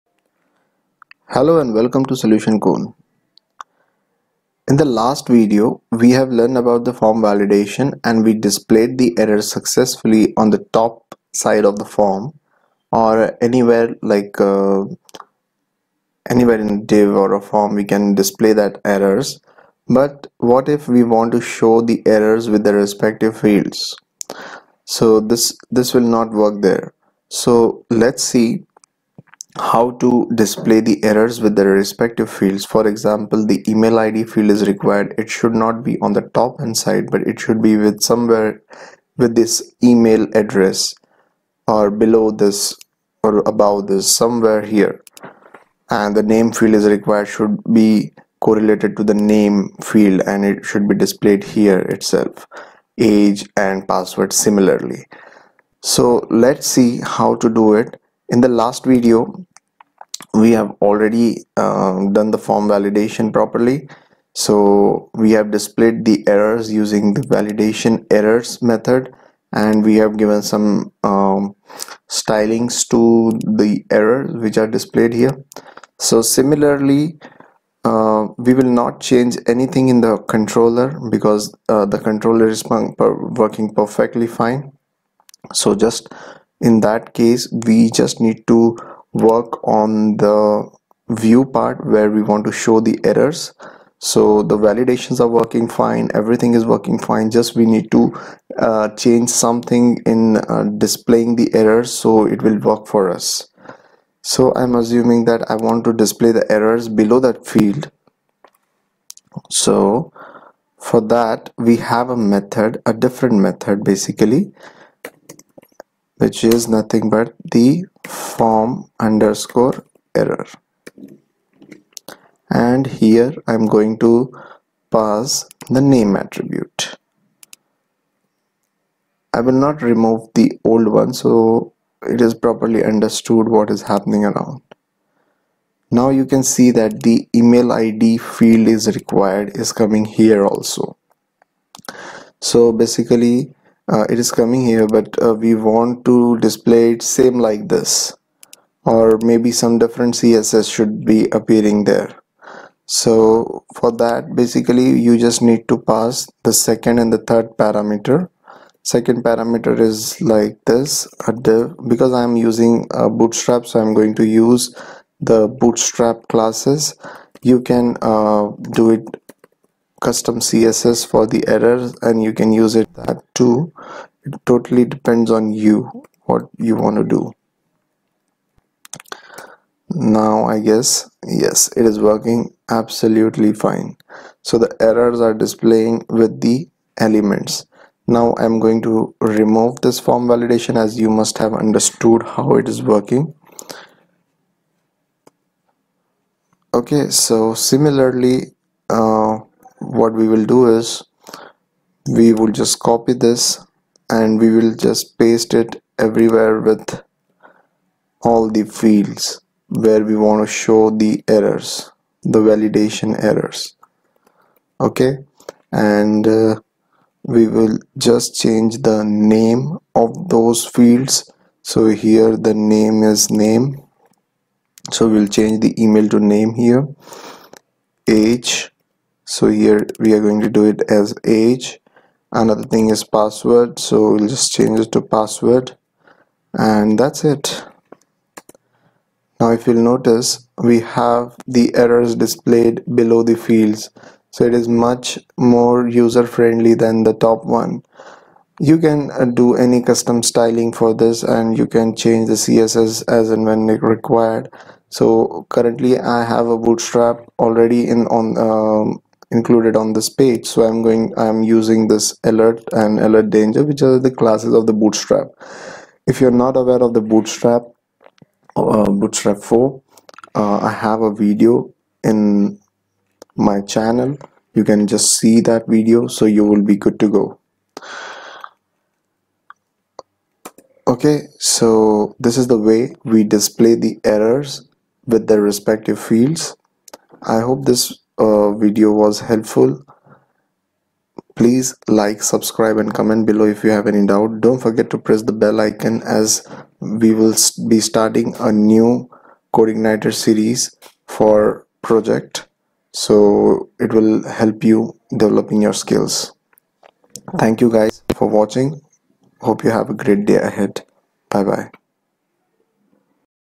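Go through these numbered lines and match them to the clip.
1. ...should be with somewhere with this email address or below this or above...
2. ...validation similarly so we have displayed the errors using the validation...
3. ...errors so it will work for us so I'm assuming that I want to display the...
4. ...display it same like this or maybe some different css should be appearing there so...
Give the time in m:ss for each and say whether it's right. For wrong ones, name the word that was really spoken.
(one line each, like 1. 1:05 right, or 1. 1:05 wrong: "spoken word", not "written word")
1. 0:37 right
2. 1:02 wrong: "properly", not "similarly"
3. 1:41 right
4. 2:26 right.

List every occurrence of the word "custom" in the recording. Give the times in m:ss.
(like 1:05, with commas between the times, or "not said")
2:50, 4:09.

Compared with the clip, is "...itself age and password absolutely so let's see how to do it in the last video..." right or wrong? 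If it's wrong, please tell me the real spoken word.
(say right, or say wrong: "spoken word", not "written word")
wrong: "similarly", not "absolutely".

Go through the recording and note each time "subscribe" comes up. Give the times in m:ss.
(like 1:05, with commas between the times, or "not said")
4:52.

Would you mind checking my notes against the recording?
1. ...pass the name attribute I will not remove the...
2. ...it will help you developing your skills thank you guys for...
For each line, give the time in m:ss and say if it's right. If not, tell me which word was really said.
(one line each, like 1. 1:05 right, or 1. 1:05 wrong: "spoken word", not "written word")
1. 2:04 right
2. 5:03 right.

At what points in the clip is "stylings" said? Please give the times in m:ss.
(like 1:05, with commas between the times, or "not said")
1:12, 4:10.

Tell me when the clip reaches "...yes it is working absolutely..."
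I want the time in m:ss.
3:01.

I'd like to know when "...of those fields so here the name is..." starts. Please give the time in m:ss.
3:40.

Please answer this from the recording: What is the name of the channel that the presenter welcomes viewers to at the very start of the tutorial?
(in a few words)
Solution Cone.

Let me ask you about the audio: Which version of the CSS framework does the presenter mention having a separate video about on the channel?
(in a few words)
Bootstrap 4.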